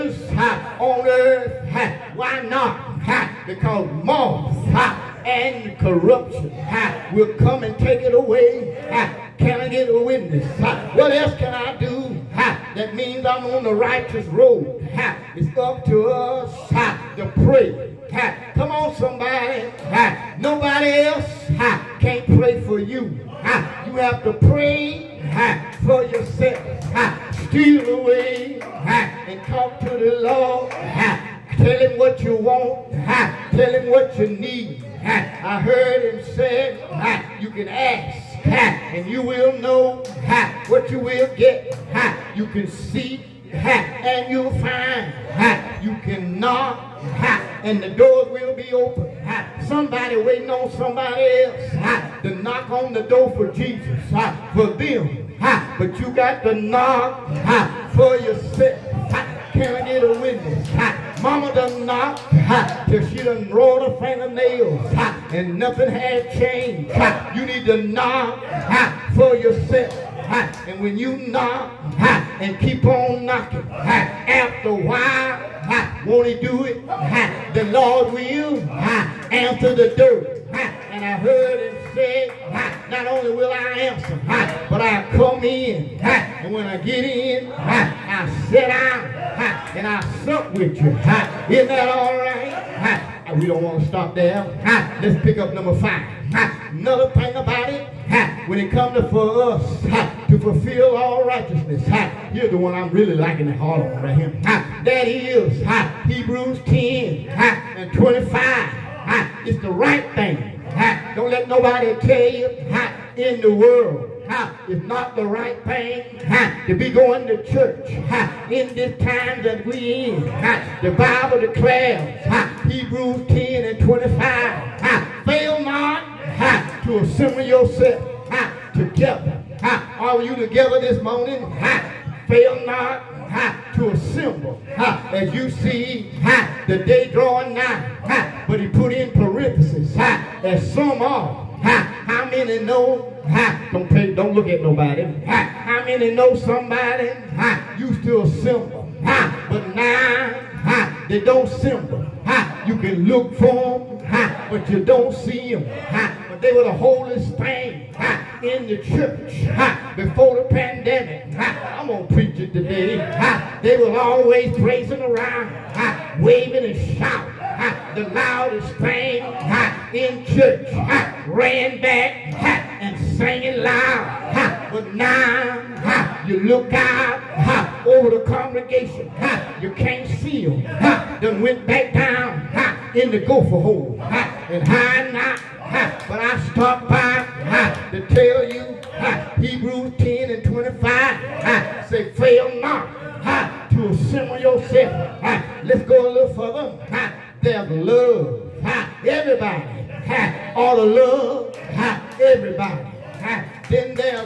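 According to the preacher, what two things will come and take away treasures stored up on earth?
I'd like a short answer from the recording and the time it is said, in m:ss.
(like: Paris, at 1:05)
moths and corruption, at 0:04.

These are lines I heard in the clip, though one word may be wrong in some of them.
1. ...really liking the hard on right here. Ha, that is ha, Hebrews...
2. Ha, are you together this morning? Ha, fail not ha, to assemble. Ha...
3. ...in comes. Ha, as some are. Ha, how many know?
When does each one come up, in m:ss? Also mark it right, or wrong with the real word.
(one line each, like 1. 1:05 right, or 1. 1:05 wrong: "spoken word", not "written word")
1. 1:42 right
2. 2:09 right
3. 2:18 wrong: "parentheses", not "comes".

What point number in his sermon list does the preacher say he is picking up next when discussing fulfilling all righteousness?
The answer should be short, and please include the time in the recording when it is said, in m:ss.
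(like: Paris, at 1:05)
5, at 1:35.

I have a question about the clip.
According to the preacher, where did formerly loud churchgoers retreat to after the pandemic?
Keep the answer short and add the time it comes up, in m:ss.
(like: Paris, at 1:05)
the gopher hole, at 3:03.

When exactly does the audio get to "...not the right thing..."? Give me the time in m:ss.
1:54.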